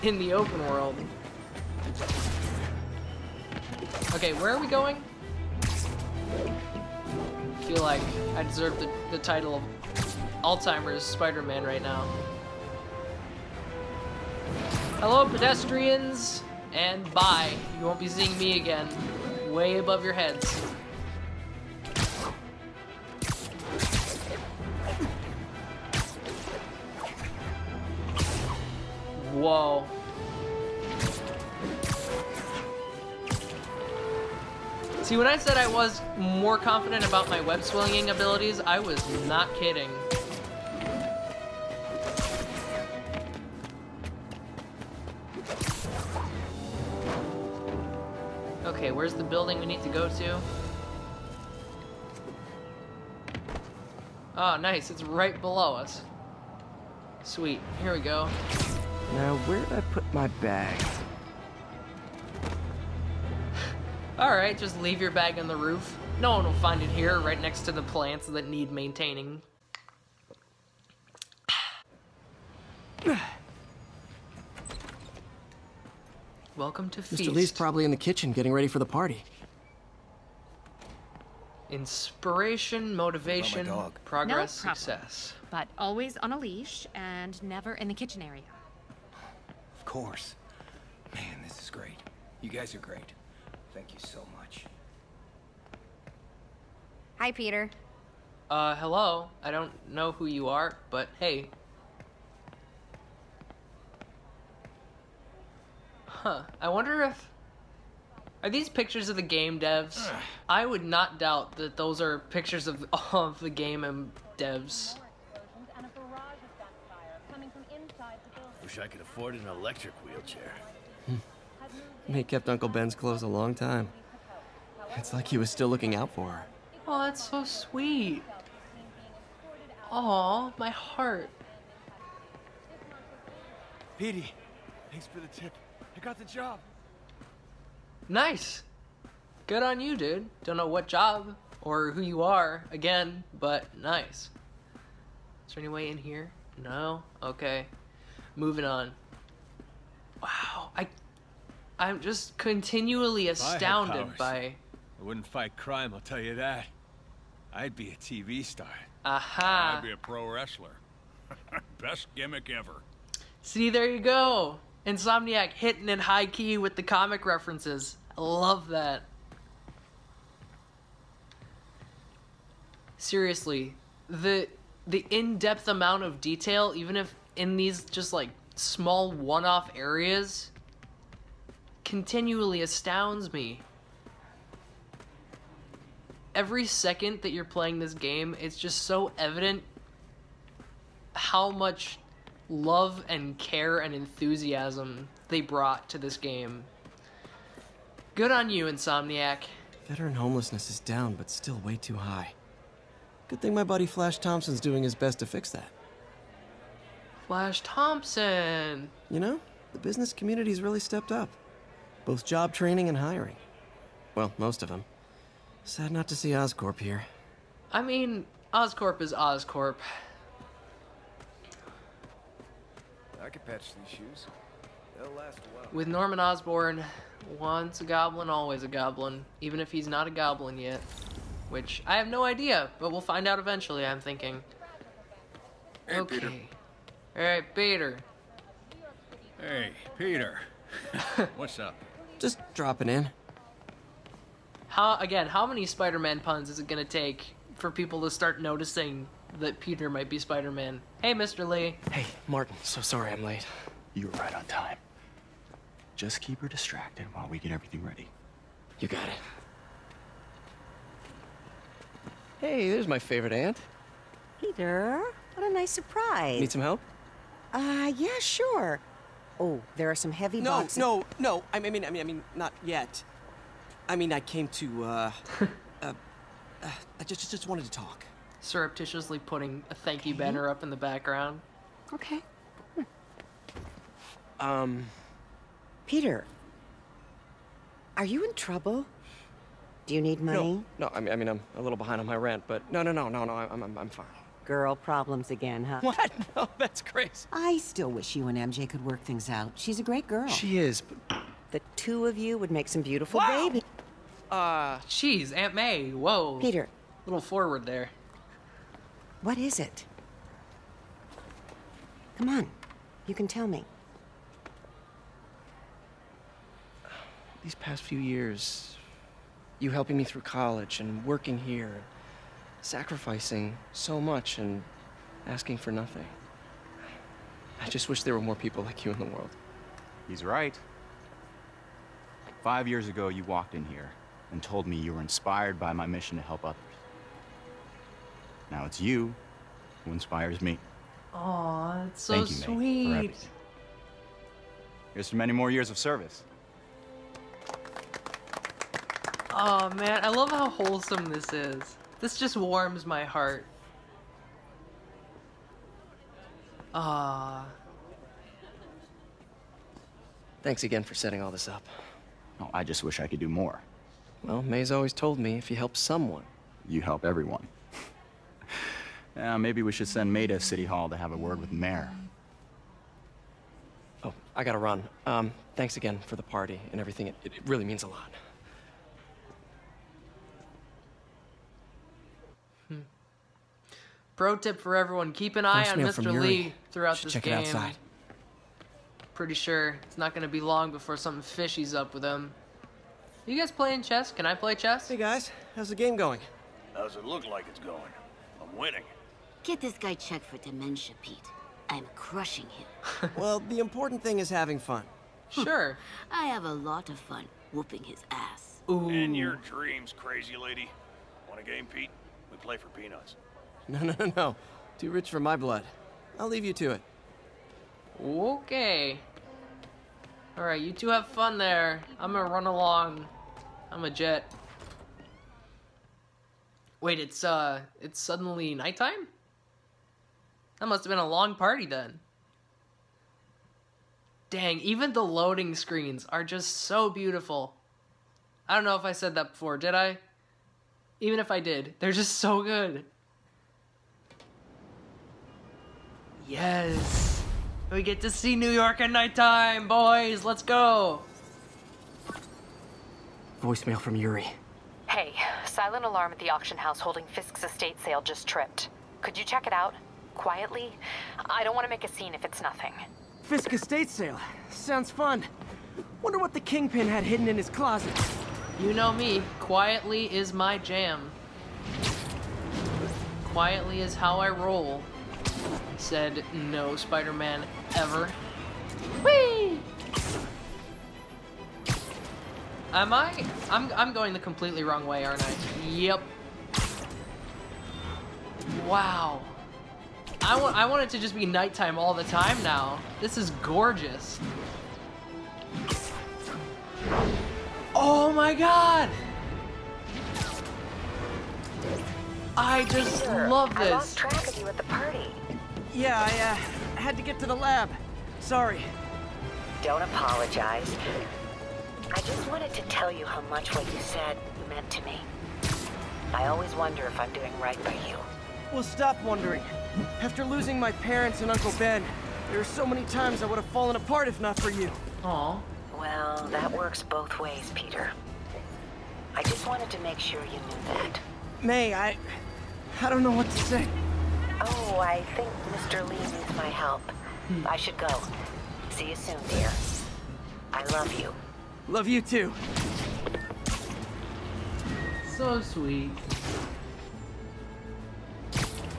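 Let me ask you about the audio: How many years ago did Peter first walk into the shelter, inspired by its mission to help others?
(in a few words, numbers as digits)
5.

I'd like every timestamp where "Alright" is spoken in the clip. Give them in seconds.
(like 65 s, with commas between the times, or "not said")
64 s, 420 s.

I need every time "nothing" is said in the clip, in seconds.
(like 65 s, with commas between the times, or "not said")
325 s, 462 s.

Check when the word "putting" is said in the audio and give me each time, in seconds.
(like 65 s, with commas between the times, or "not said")
279 s.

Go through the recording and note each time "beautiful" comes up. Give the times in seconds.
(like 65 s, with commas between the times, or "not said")
302 s, 436 s.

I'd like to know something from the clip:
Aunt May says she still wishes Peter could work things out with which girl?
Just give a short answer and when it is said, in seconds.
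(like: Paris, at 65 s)
MJ, at 298 s.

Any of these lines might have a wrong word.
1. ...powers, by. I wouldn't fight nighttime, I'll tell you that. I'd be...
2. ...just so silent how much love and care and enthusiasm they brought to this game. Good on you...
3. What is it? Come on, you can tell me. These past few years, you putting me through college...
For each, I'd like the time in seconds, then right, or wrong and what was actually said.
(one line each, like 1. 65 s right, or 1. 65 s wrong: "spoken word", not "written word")
1. 154 s wrong: "crime", not "nighttime"
2. 188 s wrong: "evident", not "silent"
3. 309 s wrong: "helping", not "putting".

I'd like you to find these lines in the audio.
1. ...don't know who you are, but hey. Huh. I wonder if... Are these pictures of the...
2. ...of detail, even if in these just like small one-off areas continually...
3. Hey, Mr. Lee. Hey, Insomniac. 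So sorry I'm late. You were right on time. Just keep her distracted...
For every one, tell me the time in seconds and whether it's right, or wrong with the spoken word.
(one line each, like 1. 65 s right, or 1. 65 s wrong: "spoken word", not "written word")
1. 99 s right
2. 176 s right
3. 251 s wrong: "Martin", not "Insomniac".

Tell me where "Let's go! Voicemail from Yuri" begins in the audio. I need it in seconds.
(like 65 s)
450 s.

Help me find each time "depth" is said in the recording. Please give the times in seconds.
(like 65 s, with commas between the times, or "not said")
175 s.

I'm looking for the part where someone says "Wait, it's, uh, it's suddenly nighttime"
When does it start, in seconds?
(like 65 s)
426 s.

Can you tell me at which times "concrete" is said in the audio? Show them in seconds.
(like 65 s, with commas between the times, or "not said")
not said.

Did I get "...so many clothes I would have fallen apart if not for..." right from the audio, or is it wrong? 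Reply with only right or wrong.
wrong.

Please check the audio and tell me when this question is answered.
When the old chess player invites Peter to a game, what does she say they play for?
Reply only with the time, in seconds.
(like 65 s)
412 s.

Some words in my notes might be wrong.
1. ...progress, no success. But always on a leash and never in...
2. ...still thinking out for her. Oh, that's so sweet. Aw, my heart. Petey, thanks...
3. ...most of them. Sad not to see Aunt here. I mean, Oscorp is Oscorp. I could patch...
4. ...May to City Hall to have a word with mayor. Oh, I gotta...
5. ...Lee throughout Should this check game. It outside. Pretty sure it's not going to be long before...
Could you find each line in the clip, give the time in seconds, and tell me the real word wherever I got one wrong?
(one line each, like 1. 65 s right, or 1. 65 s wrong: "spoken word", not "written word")
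1. 84 s right
2. 125 s wrong: "looking", not "thinking"
3. 214 s wrong: "Oscorp", not "Aunt"
4. 370 s right
5. 386 s right.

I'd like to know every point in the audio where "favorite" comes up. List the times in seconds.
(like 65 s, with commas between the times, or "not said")
262 s.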